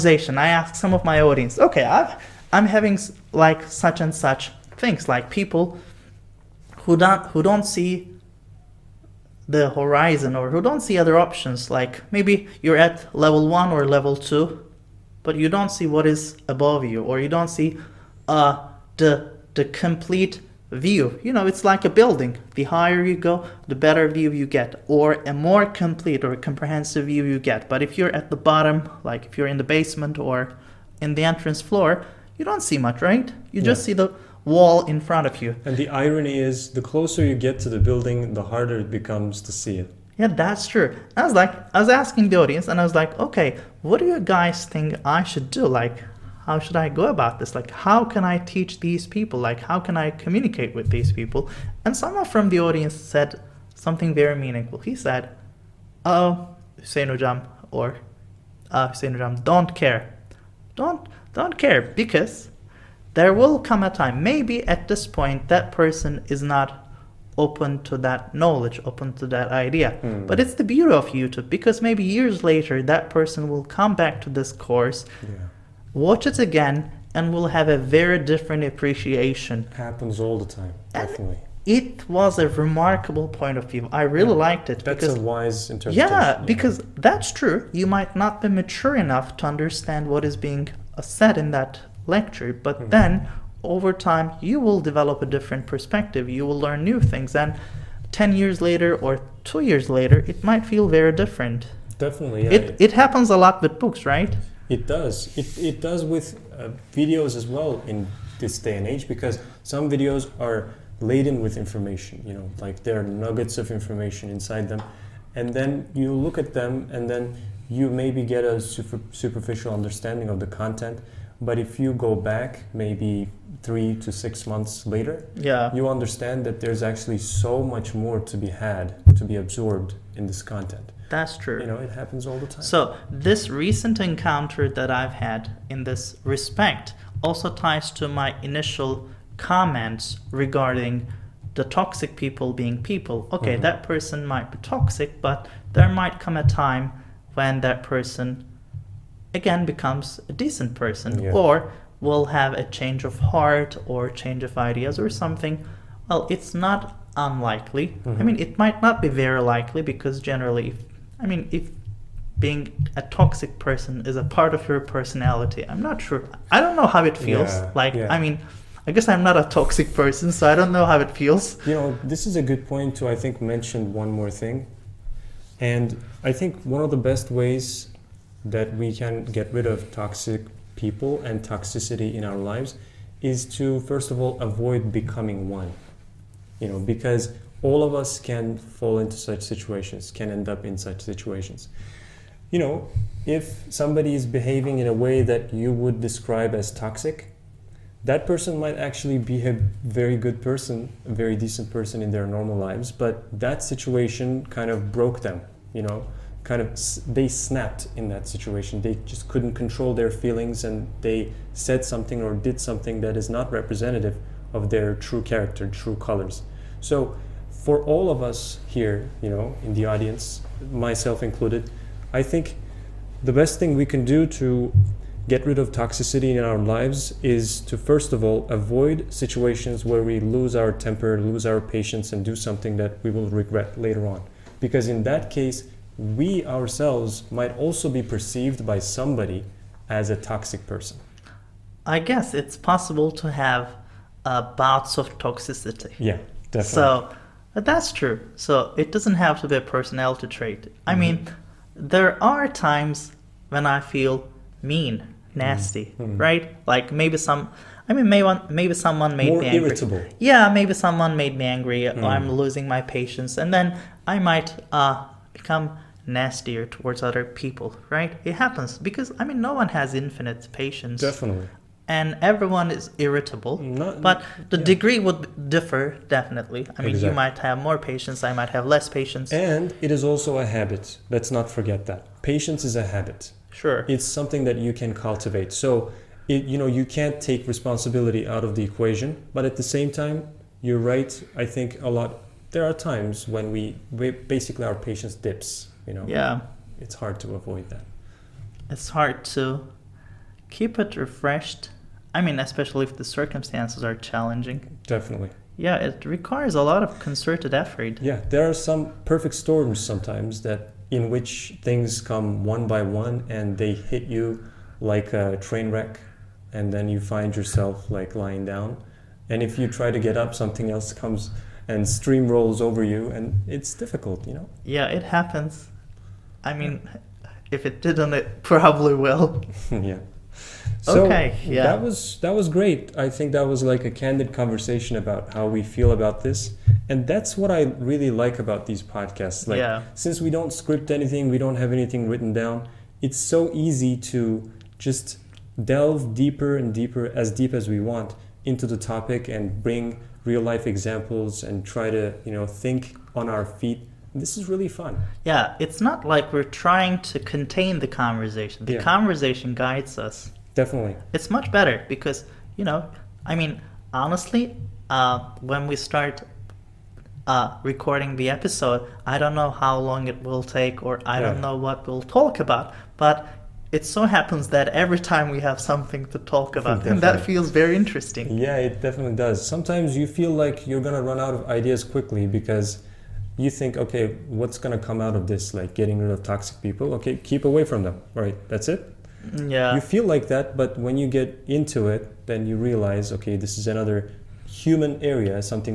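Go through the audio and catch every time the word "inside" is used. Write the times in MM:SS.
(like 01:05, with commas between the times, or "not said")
01:54.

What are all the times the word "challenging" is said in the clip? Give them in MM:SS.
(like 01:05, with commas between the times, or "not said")
05:03.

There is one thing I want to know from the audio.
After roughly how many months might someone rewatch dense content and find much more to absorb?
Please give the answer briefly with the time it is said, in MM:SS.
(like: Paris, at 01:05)
3 to 6 months, at 02:03.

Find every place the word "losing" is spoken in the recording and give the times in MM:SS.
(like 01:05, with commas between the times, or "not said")
04:22.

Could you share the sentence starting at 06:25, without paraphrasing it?
Like getting rid of toxic people?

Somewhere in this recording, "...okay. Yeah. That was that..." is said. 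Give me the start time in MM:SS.
05:31.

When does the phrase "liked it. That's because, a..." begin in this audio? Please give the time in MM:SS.
01:24.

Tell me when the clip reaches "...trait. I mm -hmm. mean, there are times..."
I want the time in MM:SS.
04:10.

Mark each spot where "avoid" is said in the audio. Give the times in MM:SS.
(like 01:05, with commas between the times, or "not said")
03:04, 03:48, 04:57.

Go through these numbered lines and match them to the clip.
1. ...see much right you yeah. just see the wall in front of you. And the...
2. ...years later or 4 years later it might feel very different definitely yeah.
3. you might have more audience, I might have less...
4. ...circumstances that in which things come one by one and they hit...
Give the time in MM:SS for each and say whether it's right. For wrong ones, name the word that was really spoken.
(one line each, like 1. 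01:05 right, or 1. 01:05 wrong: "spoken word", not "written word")
1. 00:32 right
2. 01:38 wrong: "2", not "4"
3. 04:37 wrong: "patience", not "audience"
4. 05:09 wrong: "sometimes", not "circumstances".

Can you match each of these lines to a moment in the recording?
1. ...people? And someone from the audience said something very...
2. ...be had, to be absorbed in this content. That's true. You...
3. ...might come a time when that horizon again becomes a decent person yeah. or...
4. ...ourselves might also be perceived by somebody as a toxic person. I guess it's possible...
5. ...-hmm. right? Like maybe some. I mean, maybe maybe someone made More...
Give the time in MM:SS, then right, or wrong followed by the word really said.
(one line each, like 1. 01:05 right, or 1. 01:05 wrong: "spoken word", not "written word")
1. 00:51 right
2. 02:08 right
3. 02:25 wrong: "person", not "horizon"
4. 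03:56 right
5. 04:16 right.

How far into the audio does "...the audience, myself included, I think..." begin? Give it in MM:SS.
03:39.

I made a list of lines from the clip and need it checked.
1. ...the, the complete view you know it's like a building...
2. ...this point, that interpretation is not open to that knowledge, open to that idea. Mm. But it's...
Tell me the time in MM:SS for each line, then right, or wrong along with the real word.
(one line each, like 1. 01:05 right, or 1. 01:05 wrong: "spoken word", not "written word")
1. 00:18 right
2. 01:04 wrong: "person", not "interpretation".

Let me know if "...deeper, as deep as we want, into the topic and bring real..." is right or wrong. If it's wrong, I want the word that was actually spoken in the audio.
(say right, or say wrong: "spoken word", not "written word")
right.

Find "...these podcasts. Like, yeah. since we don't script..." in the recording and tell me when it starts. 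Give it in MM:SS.
05:38.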